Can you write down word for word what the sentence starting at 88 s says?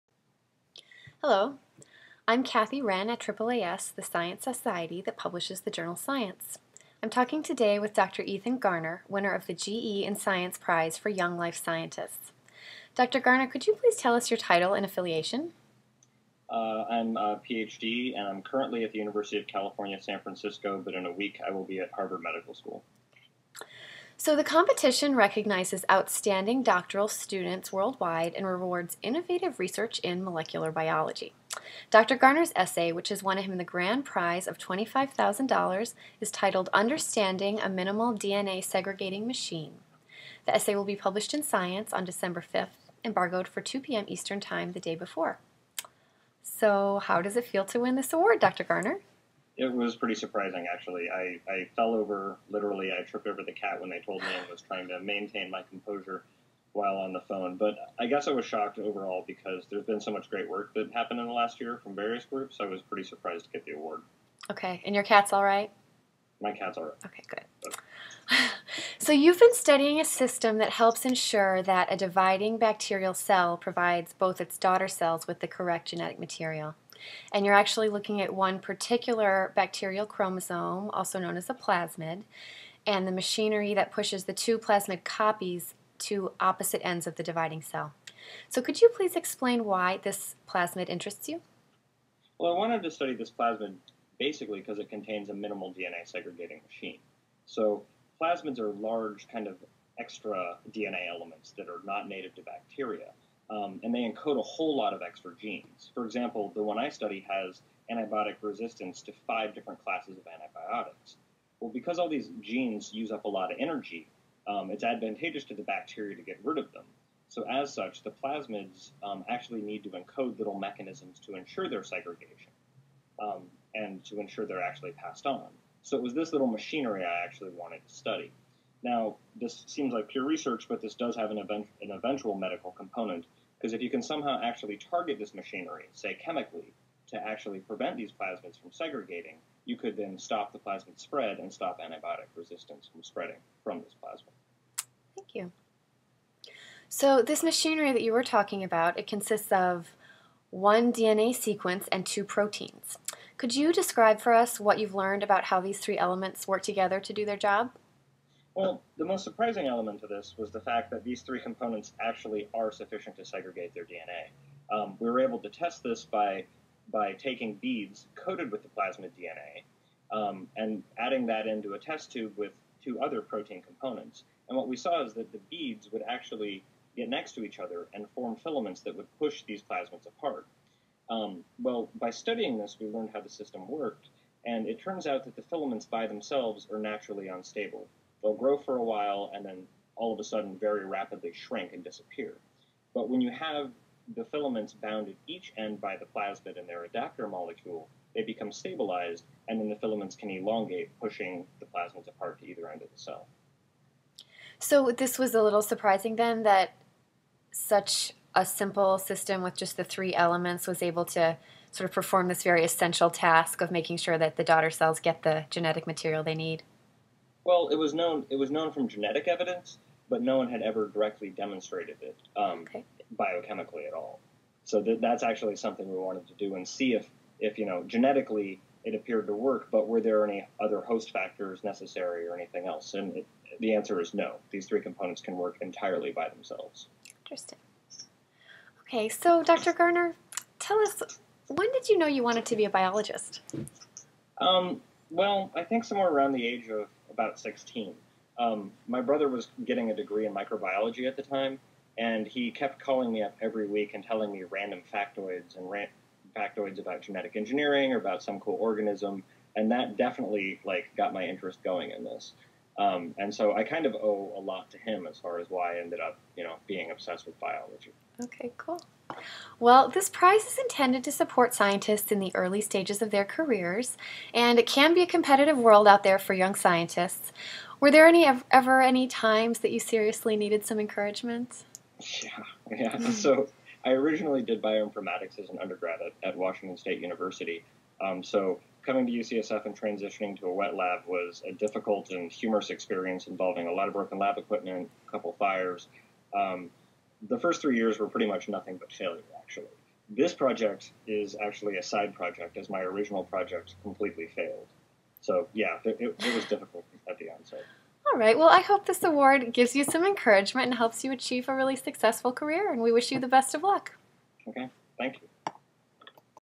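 So could you please explain why this plasmid interests you?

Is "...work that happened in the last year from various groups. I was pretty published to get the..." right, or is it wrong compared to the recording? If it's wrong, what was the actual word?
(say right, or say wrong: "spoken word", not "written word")
wrong: "surprised", not "published".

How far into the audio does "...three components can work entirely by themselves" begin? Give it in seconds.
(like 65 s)
234 s.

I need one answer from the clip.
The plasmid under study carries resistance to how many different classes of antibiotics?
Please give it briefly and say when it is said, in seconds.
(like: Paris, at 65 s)
5, at 109 s.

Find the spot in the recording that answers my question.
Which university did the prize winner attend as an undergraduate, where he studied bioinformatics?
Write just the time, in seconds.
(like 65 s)
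286 s.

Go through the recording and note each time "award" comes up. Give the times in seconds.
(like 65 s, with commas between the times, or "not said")
48 s, 63 s, 309 s.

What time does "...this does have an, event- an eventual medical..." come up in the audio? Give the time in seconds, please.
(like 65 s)
130 s.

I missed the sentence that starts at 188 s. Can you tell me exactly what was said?
They'll grow for a while and then all of a sudden very rapidly shrink and disappear.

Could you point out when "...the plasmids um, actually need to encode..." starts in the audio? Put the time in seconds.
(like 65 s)
118 s.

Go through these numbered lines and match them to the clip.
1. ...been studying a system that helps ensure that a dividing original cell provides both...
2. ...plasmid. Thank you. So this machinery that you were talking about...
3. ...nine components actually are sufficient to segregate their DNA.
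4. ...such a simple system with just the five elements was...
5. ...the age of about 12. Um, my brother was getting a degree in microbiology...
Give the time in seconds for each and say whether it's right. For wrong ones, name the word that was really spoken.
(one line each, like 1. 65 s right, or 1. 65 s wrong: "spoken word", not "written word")
1. 69 s wrong: "bacterial", not "original"
2. 144 s right
3. 161 s wrong: "three", not "nine"
4. 207 s wrong: "three", not "five"
5. 246 s wrong: "16", not "12".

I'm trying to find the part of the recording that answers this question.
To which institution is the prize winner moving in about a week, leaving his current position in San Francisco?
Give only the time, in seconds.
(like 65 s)
21 s.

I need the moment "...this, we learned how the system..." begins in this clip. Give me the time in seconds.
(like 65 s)
182 s.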